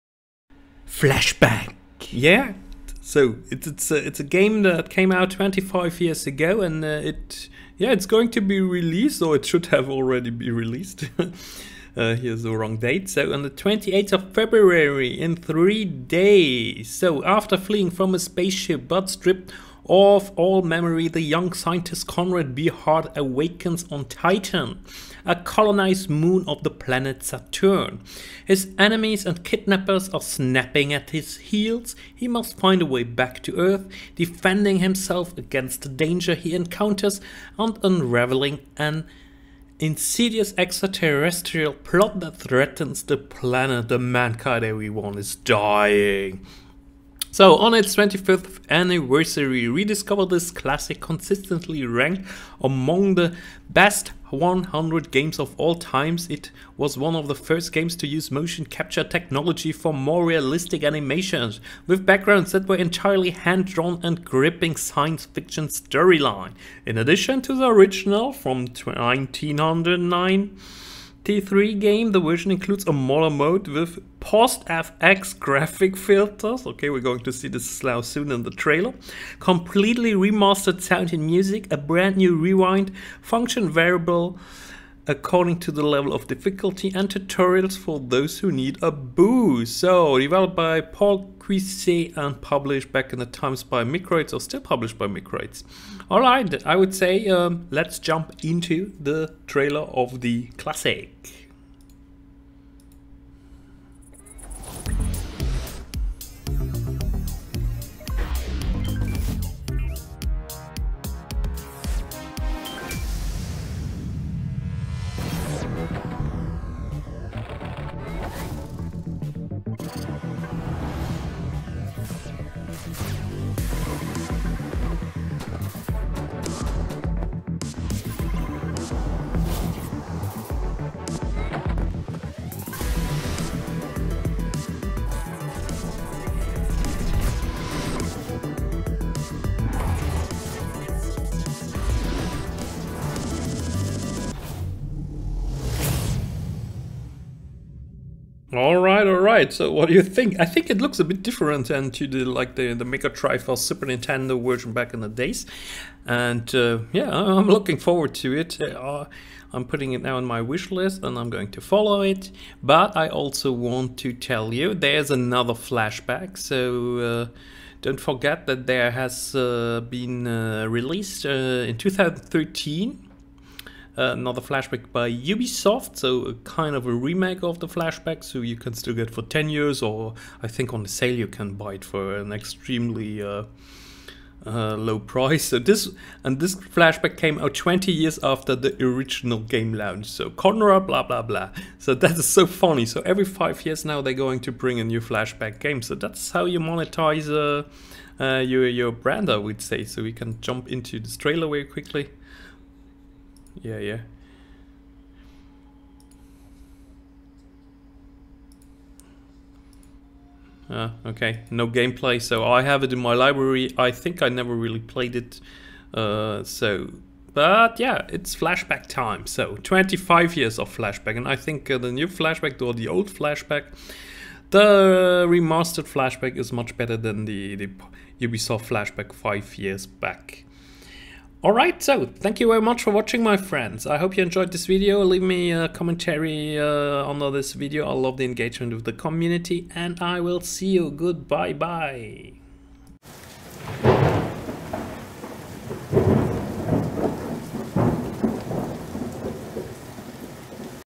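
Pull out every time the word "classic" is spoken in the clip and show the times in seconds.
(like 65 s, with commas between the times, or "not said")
50 s, 100 s.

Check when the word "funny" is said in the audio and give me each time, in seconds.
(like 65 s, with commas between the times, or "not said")
192 s.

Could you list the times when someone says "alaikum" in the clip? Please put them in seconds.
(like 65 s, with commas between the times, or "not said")
not said.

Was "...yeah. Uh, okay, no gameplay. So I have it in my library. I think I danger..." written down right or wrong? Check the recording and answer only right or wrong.
wrong.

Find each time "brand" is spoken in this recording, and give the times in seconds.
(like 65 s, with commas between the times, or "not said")
81 s, 198 s.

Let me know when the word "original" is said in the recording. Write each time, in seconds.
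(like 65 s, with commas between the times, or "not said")
67 s, 188 s.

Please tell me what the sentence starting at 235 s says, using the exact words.
Leave me a commentary uh, under this video.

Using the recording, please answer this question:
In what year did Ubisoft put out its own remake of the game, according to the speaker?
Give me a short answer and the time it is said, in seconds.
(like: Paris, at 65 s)
2013, at 171 s.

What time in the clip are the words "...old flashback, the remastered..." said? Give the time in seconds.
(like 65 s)
222 s.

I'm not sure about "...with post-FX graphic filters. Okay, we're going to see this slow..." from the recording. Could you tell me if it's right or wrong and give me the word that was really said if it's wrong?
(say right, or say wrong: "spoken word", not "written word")
right.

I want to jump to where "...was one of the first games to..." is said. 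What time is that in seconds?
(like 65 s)
56 s.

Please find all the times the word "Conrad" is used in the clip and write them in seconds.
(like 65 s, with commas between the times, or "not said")
22 s, 190 s.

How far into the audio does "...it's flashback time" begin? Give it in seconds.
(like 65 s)
218 s.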